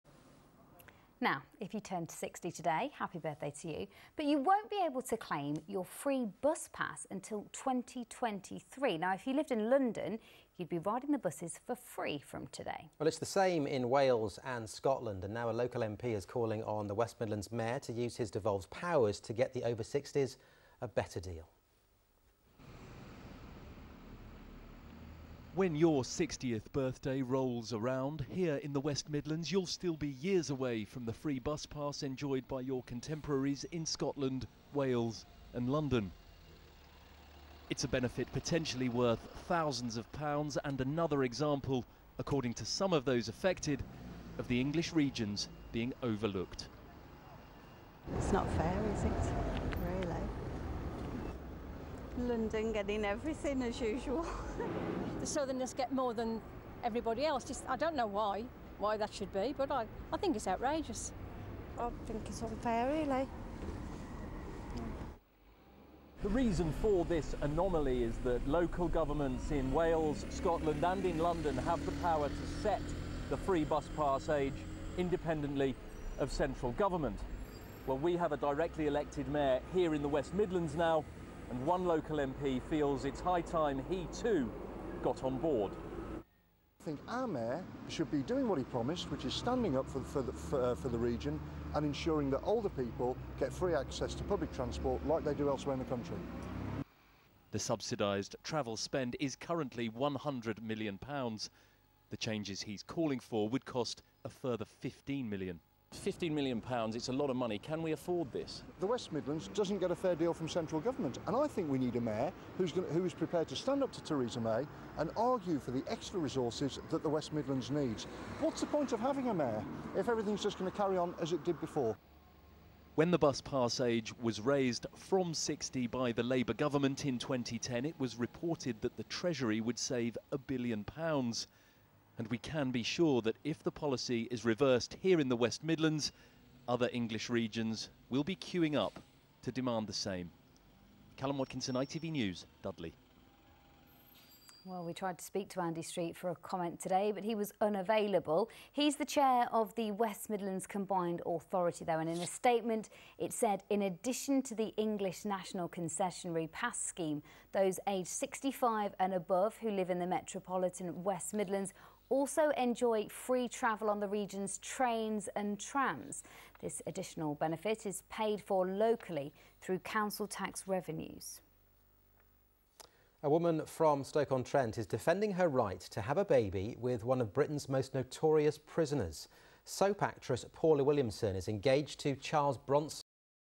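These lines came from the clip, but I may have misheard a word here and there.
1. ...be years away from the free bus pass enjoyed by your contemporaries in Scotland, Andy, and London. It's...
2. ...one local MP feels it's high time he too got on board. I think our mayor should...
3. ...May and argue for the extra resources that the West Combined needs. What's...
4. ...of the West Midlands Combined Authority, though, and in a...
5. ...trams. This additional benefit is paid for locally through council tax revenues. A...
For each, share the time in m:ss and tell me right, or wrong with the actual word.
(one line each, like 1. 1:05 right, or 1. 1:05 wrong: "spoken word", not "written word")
1. 0:29 wrong: "Wales", not "Andy"
2. 1:21 right
3. 1:54 wrong: "Midlands", not "Combined"
4. 2:29 right
5. 2:45 right.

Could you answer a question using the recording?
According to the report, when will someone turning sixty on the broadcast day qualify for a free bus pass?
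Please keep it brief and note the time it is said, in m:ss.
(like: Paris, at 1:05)
2023, at 0:07.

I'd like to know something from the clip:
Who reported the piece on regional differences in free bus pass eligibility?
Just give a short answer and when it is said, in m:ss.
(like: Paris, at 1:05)
Callum Watkinson, at 2:21.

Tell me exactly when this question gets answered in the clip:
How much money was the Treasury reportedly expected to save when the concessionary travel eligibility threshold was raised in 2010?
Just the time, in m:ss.
2:10.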